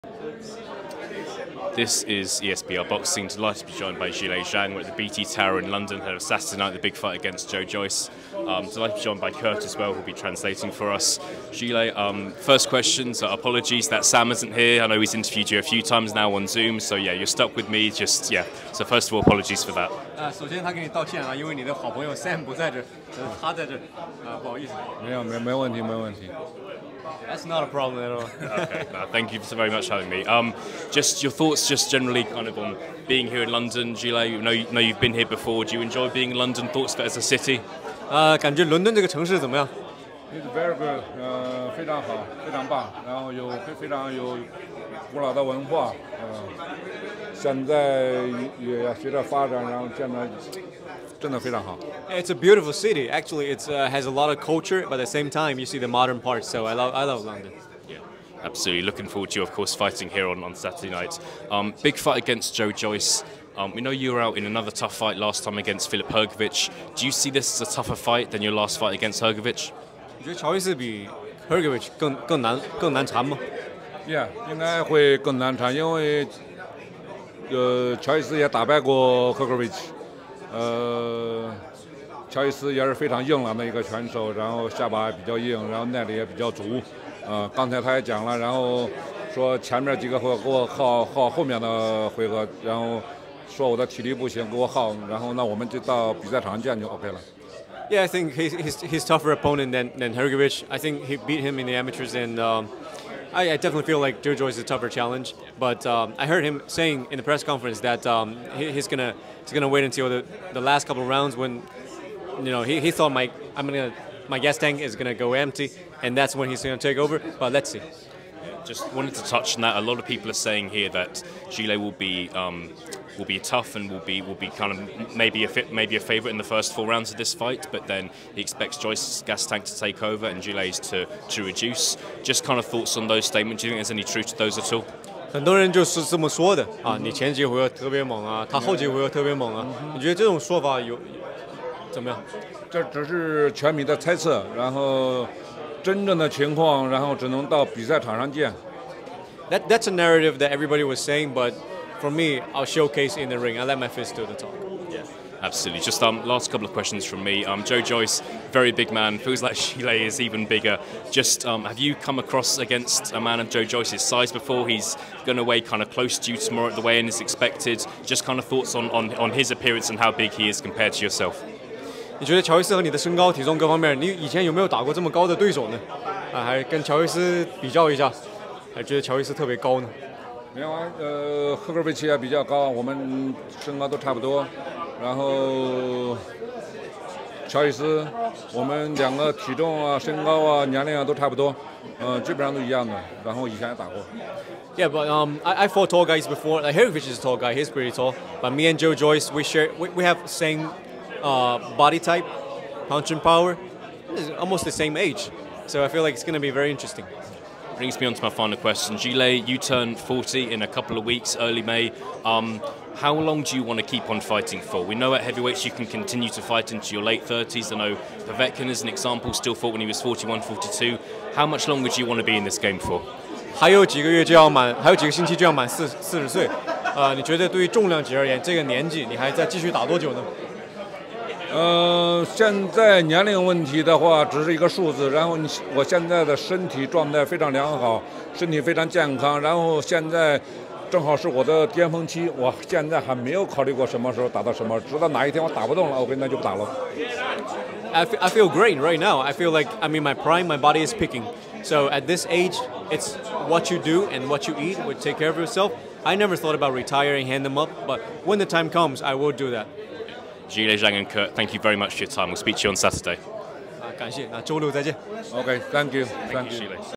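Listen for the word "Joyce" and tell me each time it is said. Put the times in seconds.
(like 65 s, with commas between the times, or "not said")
7 s, 62 s, 104 s, 128 s, 157 s, 163 s, 198 s.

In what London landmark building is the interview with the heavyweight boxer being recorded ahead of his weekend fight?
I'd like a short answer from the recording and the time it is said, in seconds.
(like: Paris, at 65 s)
BT Tower, at 4 s.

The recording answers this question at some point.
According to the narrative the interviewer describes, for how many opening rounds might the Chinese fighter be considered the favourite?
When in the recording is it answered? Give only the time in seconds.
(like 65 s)
126 s.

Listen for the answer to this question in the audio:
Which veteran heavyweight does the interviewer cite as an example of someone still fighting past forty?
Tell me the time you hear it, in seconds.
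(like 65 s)
217 s.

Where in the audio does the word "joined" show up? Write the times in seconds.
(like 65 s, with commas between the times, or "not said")
3 s, 9 s.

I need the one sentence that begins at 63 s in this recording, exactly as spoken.
Um, we know you were out in another tough fight last time against Filip Hrgovic.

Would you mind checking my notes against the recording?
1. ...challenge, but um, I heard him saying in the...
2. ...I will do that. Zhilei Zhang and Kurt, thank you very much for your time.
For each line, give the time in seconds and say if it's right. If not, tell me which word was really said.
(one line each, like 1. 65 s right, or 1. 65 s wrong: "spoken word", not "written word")
1. 104 s right
2. 259 s right.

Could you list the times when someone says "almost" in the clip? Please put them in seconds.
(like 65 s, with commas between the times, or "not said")
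204 s.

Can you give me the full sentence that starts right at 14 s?
I know he's interviewed you a few times now on Zoom, so yeah, you're stuck with me.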